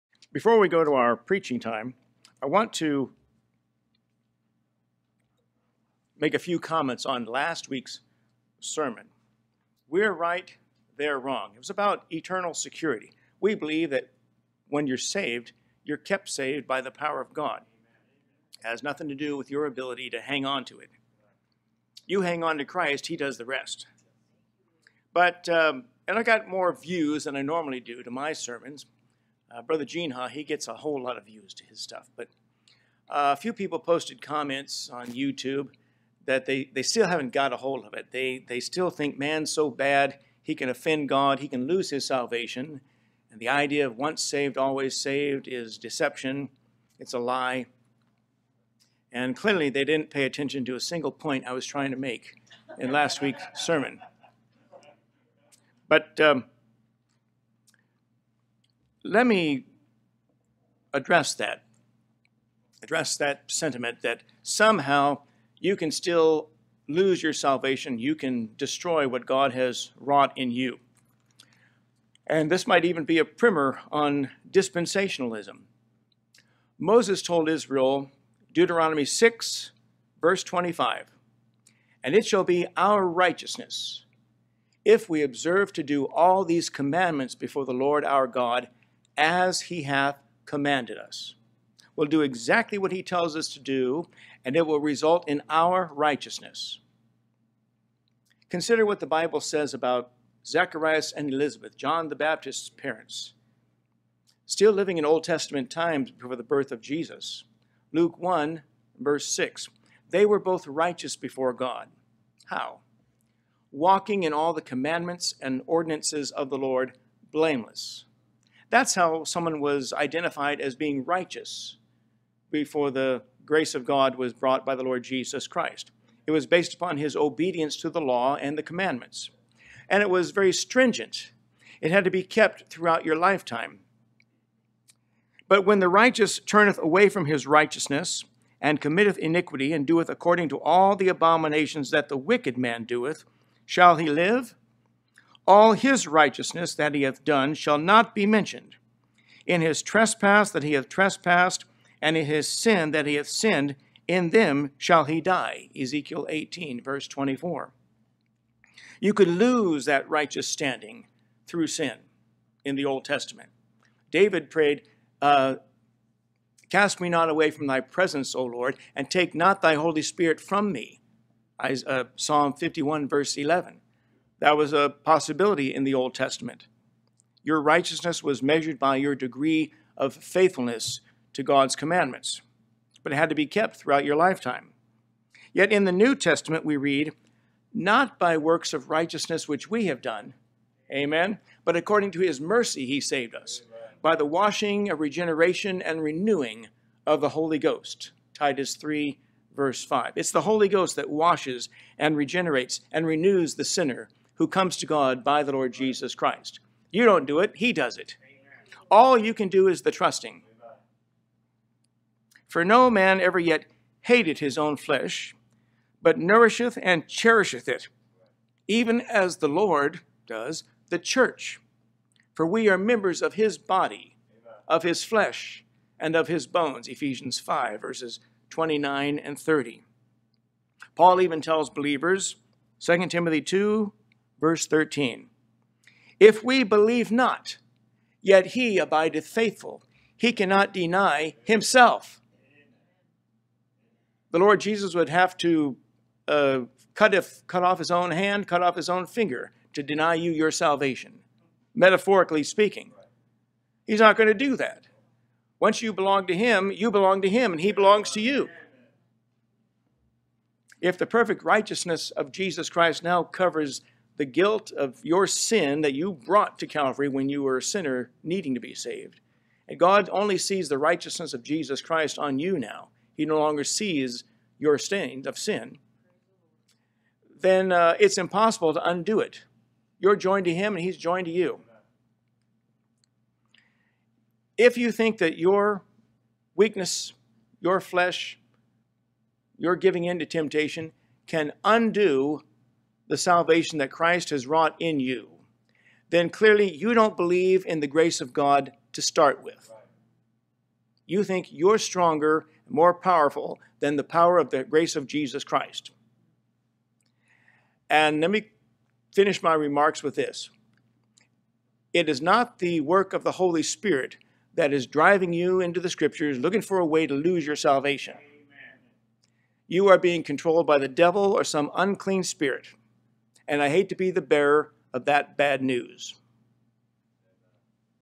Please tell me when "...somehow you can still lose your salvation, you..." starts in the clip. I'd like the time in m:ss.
1:04.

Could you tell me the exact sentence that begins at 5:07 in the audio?
And let me finish my remarks with this.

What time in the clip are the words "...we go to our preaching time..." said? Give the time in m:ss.
0:00.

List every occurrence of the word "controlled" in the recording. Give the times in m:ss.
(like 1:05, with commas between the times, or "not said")
5:20.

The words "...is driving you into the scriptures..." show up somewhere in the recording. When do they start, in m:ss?
5:14.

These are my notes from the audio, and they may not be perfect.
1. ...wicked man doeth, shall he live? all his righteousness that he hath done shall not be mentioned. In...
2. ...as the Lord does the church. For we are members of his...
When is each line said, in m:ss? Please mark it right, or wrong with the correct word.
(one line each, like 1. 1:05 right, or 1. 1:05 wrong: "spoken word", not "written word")
1. 2:22 right
2. 3:39 right.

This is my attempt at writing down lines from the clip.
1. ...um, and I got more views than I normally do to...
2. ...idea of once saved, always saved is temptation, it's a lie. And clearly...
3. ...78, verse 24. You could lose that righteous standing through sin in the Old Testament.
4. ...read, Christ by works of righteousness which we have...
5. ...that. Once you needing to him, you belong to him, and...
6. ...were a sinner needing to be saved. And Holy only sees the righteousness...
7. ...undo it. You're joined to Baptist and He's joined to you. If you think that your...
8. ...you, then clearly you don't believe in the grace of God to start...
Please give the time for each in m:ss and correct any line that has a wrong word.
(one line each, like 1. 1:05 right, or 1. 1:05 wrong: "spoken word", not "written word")
1. 0:25 right
2. 0:43 wrong: "deception", not "temptation"
3. 2:36 wrong: "18", not "78"
4. 3:06 wrong: "Not", not "Christ"
5. 4:14 wrong: "belong", not "needing"
6. 4:27 wrong: "God", not "Holy"
7. 4:38 wrong: "Him", not "Baptist"
8. 4:55 right.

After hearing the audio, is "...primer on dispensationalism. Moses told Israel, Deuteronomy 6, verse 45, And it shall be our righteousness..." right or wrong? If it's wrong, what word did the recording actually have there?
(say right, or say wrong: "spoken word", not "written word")
wrong: "25", not "45".